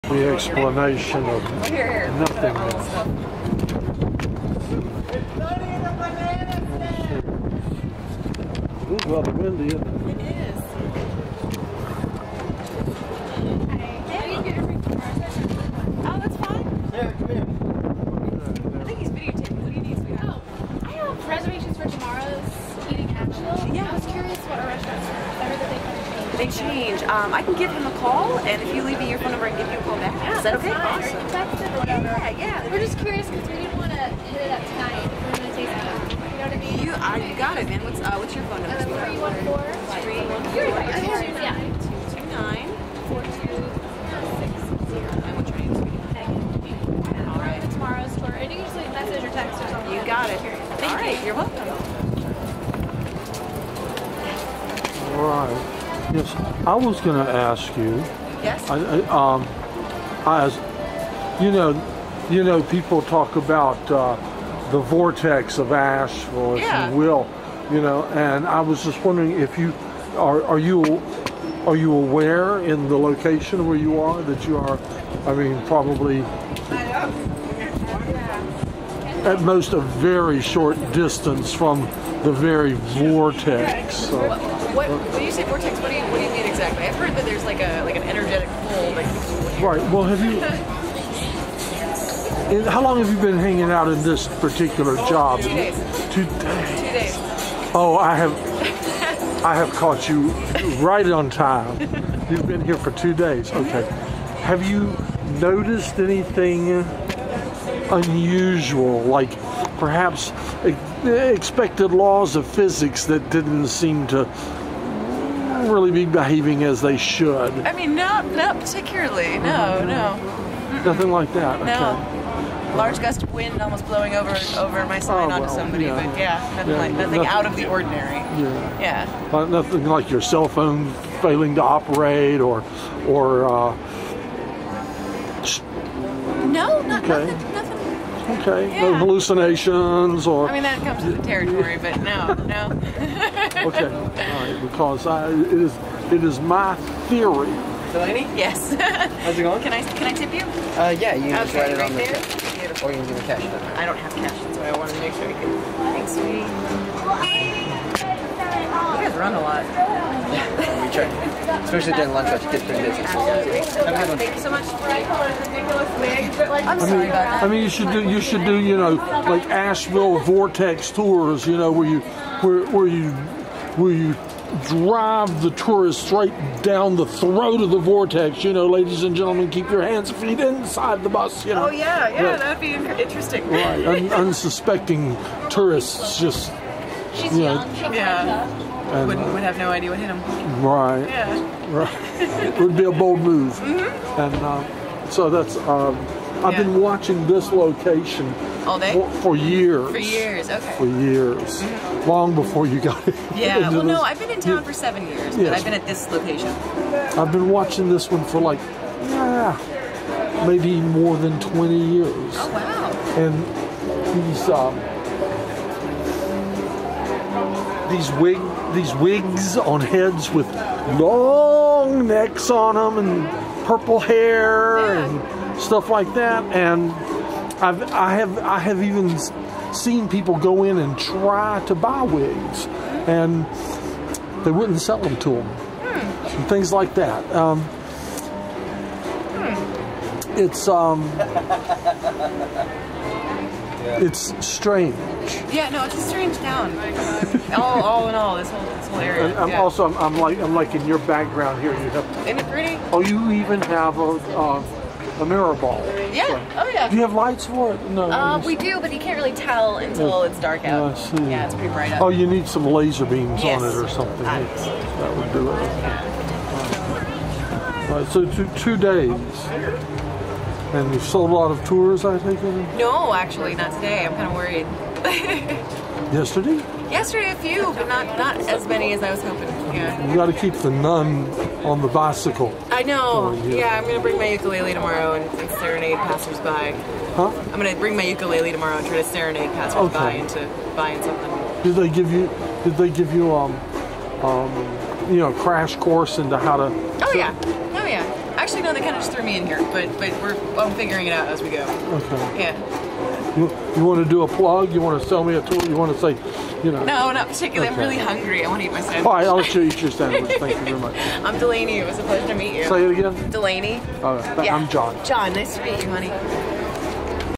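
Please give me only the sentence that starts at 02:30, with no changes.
Uh, yeah, you can okay, write it right on there.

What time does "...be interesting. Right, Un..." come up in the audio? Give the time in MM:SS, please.
03:02.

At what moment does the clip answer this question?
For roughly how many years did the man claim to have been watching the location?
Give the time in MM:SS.
03:30.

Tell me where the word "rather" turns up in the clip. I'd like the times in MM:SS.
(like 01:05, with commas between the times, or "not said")
00:09.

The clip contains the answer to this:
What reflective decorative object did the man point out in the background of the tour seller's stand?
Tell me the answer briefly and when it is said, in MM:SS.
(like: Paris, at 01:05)
mirror ball, at 04:15.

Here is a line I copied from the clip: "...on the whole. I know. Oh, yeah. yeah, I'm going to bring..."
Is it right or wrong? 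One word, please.
wrong.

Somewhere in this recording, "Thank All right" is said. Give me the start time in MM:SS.
00:50.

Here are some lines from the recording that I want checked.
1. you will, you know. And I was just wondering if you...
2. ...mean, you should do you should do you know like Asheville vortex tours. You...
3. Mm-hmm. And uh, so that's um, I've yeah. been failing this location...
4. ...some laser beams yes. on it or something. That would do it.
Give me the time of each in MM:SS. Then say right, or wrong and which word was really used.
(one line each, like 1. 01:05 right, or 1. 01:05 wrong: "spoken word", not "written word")
1. 01:06 right
2. 02:47 right
3. 03:13 wrong: "watching", not "failing"
4. 04:22 right.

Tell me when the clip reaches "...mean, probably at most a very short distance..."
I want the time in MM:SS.
01:15.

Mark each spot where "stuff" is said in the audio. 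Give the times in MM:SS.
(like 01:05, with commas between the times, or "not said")
03:45.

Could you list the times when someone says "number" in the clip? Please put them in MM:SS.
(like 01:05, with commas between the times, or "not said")
00:29, 00:38.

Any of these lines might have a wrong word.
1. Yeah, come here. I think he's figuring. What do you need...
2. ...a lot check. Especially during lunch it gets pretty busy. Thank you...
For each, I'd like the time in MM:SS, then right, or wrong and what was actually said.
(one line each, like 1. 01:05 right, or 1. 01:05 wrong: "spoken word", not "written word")
1. 00:16 wrong: "videotaping", not "figuring"
2. 02:39 right.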